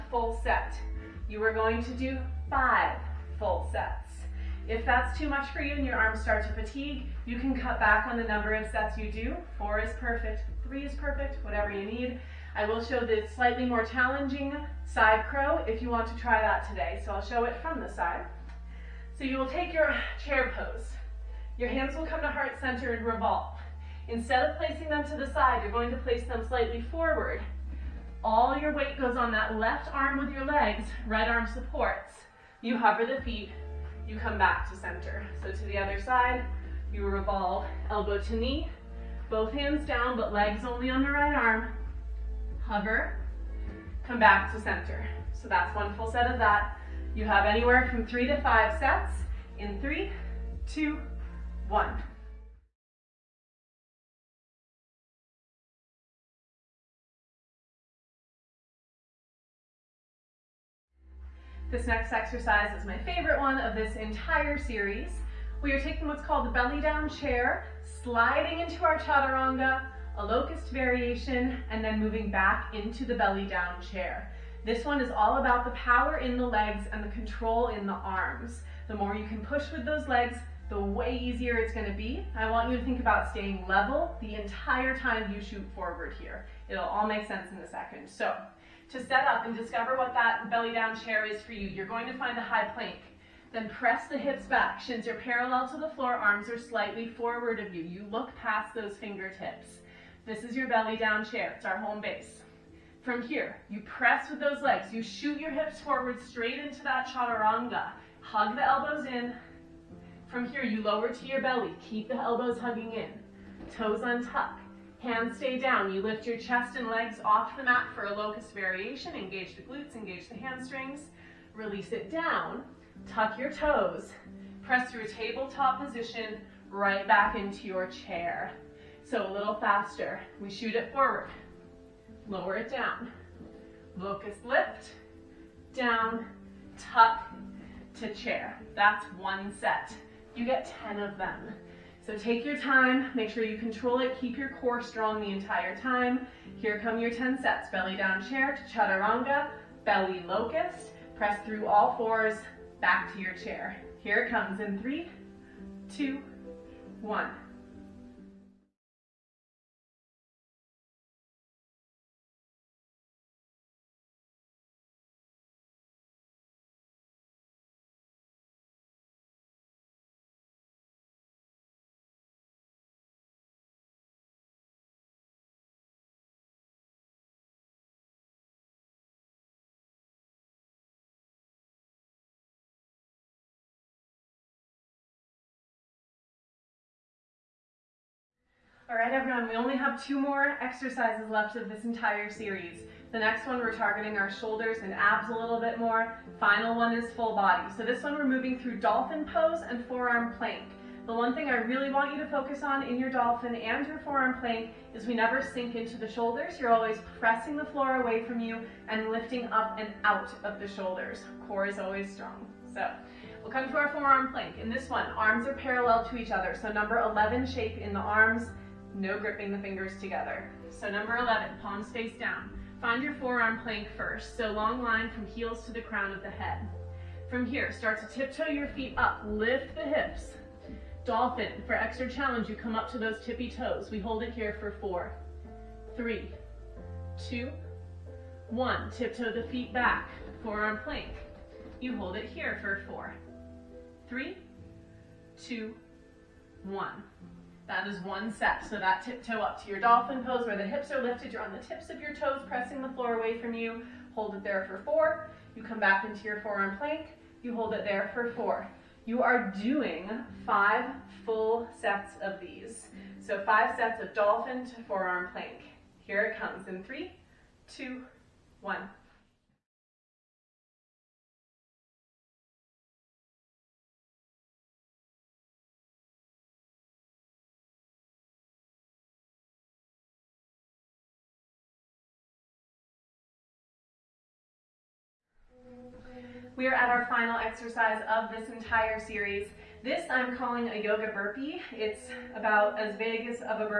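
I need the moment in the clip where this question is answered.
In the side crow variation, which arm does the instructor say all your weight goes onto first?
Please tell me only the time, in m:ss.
0:29.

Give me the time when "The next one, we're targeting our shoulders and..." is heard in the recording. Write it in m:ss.
3:13.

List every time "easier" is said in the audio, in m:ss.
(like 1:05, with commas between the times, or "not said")
1:21.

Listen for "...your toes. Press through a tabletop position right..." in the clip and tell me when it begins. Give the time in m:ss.
2:03.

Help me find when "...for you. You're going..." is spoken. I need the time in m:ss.
1:31.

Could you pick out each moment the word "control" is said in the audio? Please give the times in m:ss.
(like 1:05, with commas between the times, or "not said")
1:17, 2:23.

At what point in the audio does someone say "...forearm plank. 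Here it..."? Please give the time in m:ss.
4:24.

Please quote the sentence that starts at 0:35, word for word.
So to the other side, you revolve, elbow to knee, both hands down, but legs only on the right arm.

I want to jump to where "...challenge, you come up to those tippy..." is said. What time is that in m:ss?
3:52.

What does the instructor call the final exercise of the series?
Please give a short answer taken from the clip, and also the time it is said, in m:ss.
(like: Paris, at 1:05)
yoga burpee, at 4:50.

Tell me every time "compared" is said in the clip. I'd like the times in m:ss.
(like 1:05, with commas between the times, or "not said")
not said.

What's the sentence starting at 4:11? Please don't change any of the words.
You're on the tips of your toes, pressing the floor away from you.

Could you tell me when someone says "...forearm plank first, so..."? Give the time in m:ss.
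3:43.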